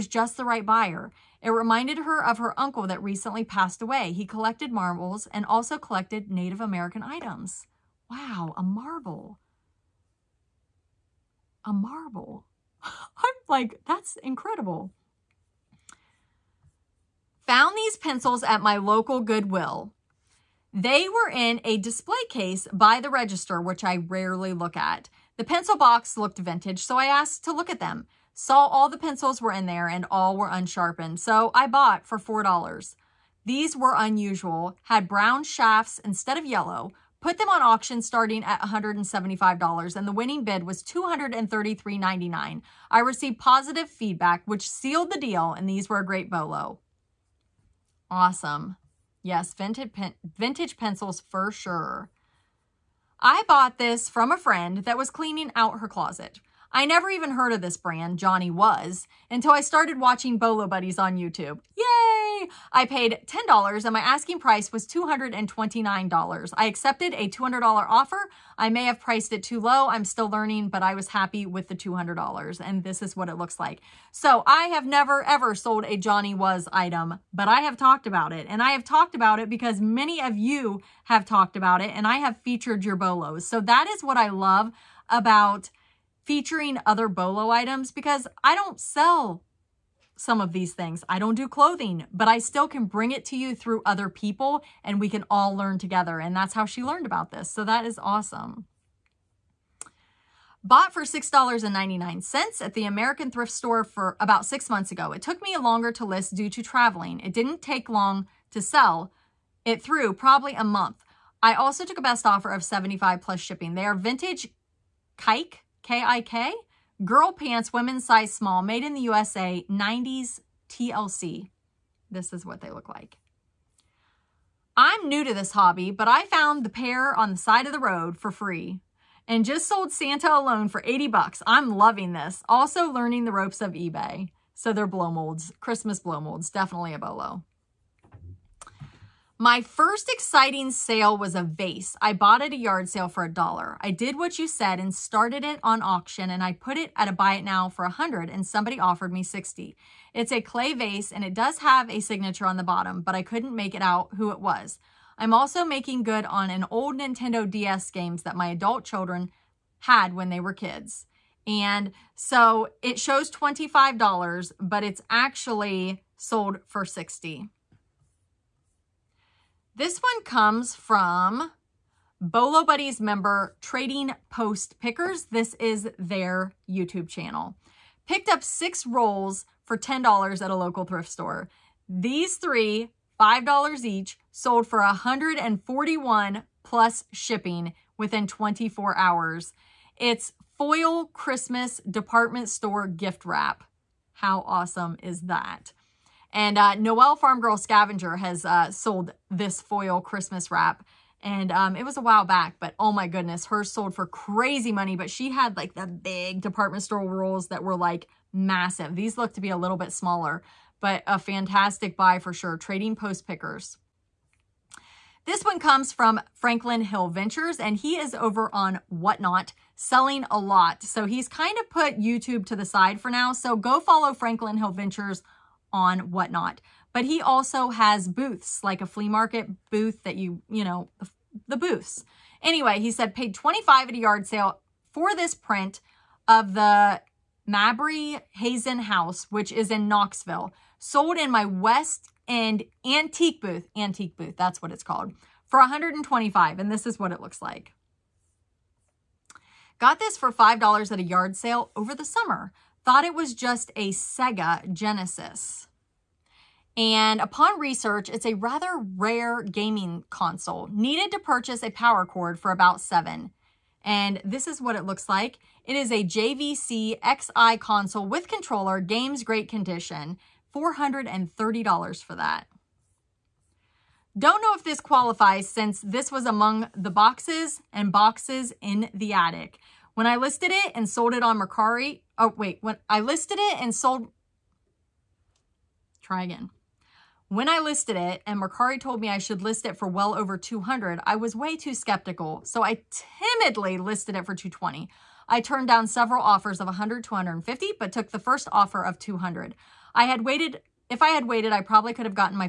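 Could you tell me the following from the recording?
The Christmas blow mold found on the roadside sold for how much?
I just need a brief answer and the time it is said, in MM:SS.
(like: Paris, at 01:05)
$80, at 02:10.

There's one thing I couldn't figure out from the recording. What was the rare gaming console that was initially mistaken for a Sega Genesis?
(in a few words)
JVC X'Eye.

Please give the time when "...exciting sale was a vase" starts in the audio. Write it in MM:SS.
02:20.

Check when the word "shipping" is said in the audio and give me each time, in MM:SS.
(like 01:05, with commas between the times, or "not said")
01:53, 03:07.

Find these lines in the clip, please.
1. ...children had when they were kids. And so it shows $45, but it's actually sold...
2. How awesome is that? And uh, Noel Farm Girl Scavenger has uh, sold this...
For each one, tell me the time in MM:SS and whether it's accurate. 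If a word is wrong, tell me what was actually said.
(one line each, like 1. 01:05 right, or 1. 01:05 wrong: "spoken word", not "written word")
1. 02:38 wrong: "25", not "45"
2. 03:14 right.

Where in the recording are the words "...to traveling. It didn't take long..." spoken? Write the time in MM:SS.
01:46.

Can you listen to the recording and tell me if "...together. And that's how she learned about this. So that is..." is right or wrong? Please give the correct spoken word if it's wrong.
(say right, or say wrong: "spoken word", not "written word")
right.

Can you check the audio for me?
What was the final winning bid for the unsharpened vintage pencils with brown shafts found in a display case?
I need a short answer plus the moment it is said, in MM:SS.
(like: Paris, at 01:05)
$233.99, at 00:40.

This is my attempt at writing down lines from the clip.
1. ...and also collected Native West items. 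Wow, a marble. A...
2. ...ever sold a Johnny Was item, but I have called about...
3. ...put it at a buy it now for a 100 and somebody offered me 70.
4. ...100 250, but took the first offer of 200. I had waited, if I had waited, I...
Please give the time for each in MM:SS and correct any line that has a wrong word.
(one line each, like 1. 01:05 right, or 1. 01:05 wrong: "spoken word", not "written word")
1. 00:05 wrong: "American", not "West"
2. 01:15 wrong: "talked", not "called"
3. 02:26 wrong: "60", not "70"
4. 04:56 right.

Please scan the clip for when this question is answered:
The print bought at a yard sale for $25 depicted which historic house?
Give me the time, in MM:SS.
03:57.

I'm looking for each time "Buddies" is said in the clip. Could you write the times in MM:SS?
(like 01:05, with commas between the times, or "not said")
01:00, 02:52.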